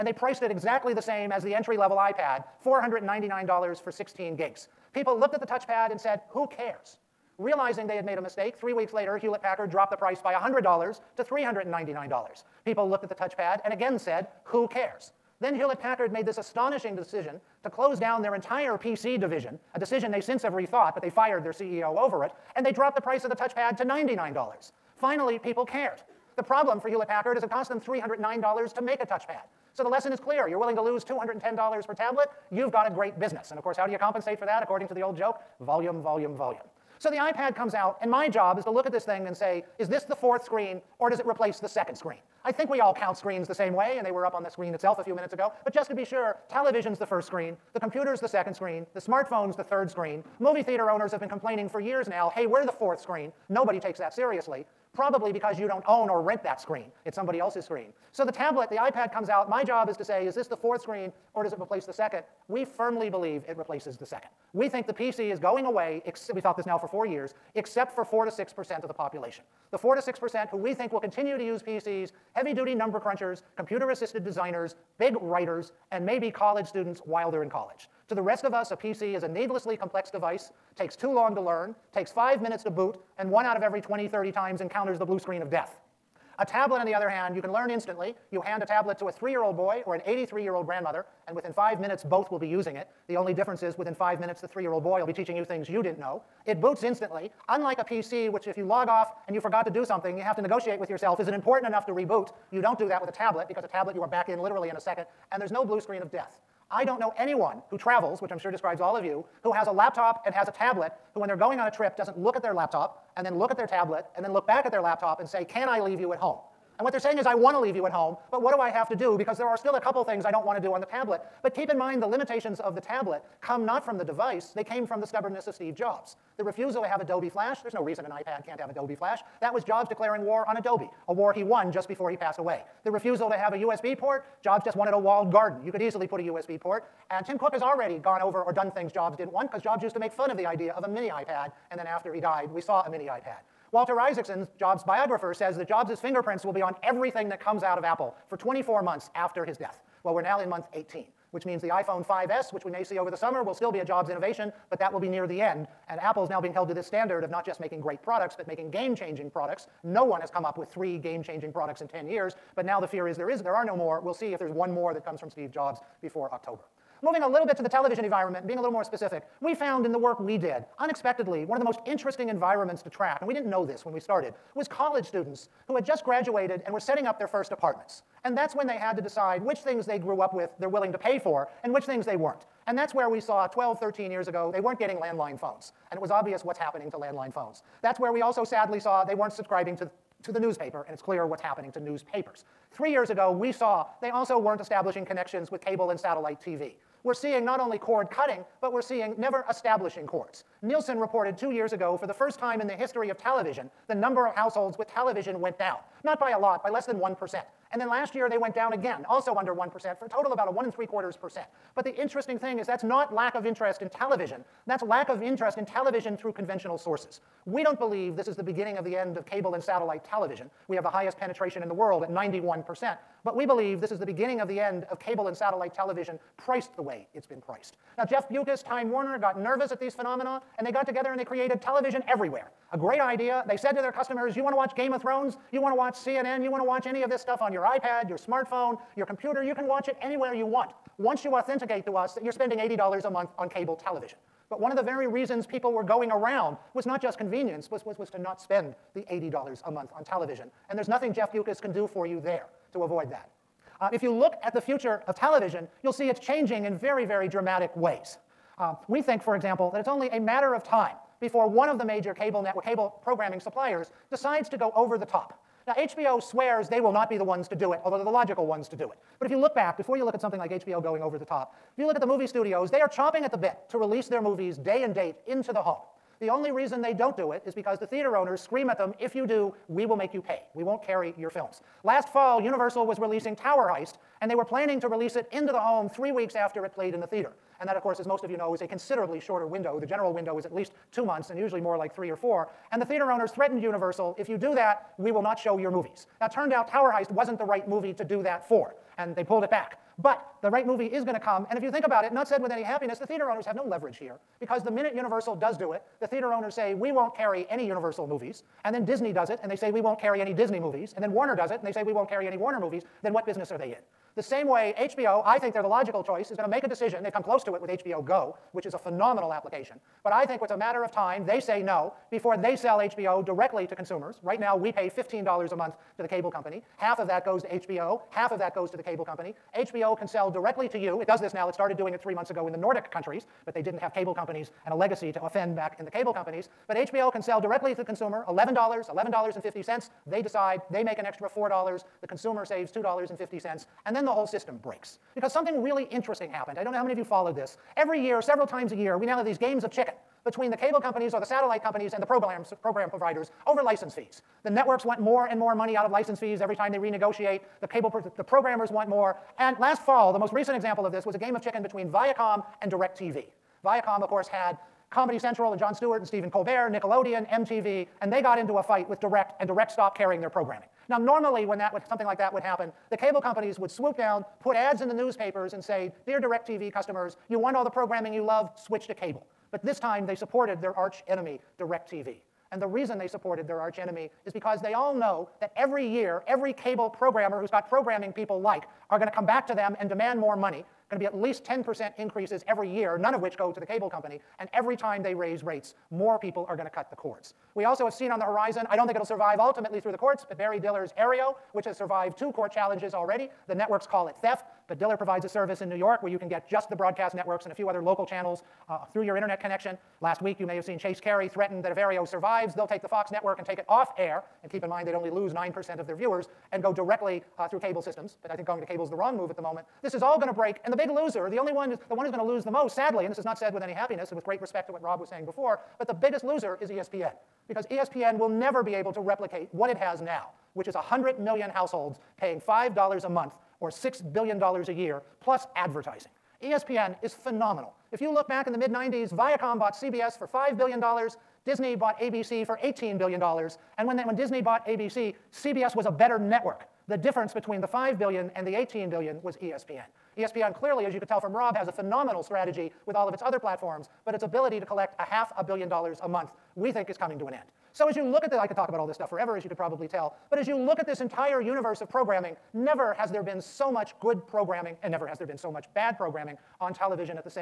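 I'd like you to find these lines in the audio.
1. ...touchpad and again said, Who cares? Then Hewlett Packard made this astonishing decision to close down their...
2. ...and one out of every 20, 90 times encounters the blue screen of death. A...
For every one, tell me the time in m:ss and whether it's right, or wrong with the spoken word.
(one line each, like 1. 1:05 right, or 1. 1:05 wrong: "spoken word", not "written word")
1. 0:13 right
2. 1:23 wrong: "30", not "90".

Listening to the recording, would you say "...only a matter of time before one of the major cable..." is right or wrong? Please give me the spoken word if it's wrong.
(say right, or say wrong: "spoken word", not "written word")
right.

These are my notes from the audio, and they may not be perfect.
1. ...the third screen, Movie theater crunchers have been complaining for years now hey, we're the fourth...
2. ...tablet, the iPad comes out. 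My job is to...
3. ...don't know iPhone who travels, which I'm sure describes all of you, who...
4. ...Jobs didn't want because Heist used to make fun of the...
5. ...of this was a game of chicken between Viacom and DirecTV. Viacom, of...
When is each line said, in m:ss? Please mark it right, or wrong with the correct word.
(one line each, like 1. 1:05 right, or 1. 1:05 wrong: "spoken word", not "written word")
1. 0:49 wrong: "owners", not "crunchers"
2. 0:58 right
3. 1:46 wrong: "anyone", not "iPhone"
4. 2:18 wrong: "Jobs", not "Heist"
5. 6:00 right.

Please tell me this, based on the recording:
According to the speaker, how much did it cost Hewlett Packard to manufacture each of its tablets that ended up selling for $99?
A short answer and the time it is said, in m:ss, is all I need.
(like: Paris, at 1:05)
$309, at 0:27.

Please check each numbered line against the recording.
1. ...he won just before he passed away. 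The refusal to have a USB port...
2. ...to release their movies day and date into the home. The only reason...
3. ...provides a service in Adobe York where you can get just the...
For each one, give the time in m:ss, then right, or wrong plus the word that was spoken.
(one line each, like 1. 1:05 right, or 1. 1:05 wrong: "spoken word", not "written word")
1. 2:11 right
2. 4:33 right
3. 6:44 wrong: "New", not "Adobe".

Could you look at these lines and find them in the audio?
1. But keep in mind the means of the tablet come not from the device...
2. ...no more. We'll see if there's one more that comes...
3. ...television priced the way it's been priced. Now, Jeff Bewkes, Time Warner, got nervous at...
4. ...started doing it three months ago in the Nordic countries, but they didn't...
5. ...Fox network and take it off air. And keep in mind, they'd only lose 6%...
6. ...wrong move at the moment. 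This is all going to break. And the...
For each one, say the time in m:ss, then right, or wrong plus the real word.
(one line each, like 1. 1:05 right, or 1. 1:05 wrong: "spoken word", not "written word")
1. 2:01 wrong: "limitations", not "means"
2. 2:43 right
3. 3:45 right
4. 5:31 right
5. 6:52 wrong: "9", not "6"
6. 6:58 right.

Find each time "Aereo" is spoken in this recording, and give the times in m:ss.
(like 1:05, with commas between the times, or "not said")
6:40, 6:51.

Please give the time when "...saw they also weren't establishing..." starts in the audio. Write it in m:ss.
3:13.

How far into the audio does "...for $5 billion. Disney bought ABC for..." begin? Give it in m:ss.
7:20.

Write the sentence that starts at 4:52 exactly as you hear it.
And the theater owners threatened Universal if you do that, we will not show your movies.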